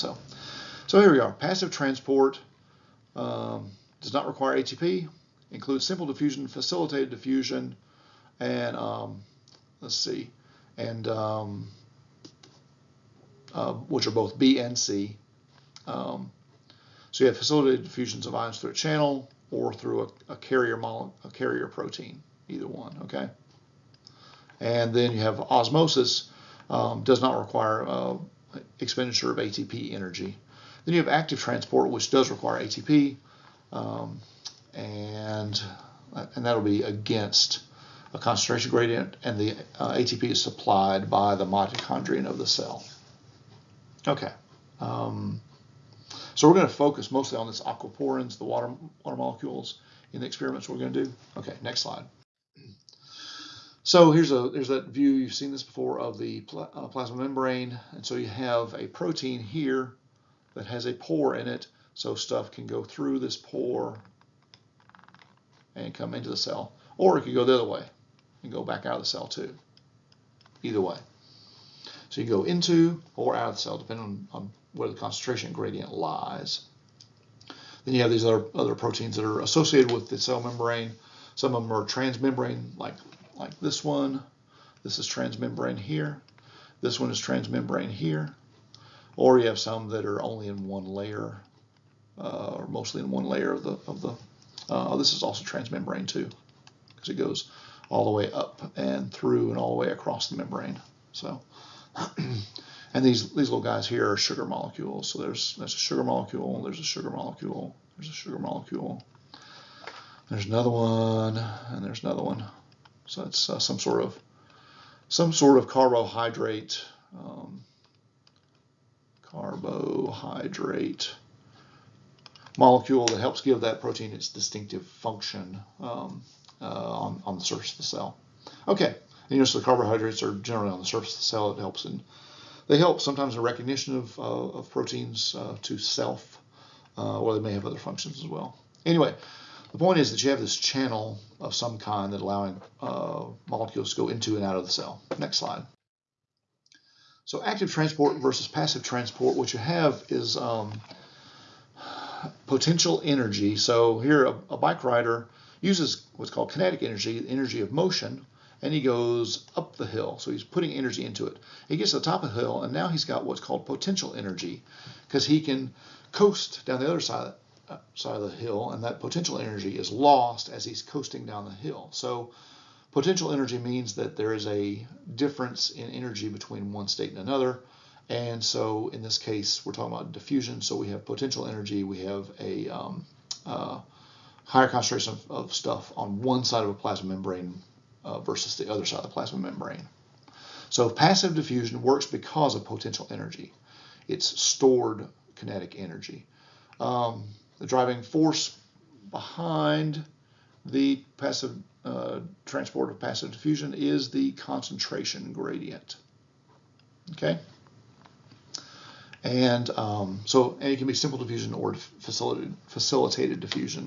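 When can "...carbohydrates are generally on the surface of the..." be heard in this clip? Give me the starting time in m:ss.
2:09.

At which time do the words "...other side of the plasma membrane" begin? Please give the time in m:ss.
3:08.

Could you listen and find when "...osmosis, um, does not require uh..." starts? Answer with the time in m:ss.
0:25.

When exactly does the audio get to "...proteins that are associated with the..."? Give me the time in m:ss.
1:18.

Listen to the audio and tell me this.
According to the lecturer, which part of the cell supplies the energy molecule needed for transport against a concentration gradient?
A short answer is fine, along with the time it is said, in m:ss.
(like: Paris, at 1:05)
Mitochondrion, at 0:41.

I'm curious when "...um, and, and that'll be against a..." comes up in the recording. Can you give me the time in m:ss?
0:33.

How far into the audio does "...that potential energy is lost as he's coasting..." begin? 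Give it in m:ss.
2:48.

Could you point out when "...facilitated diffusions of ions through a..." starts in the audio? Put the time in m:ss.
0:17.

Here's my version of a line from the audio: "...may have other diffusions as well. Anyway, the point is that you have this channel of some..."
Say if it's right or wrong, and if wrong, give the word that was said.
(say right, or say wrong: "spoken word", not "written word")
wrong: "functions", not "diffusions".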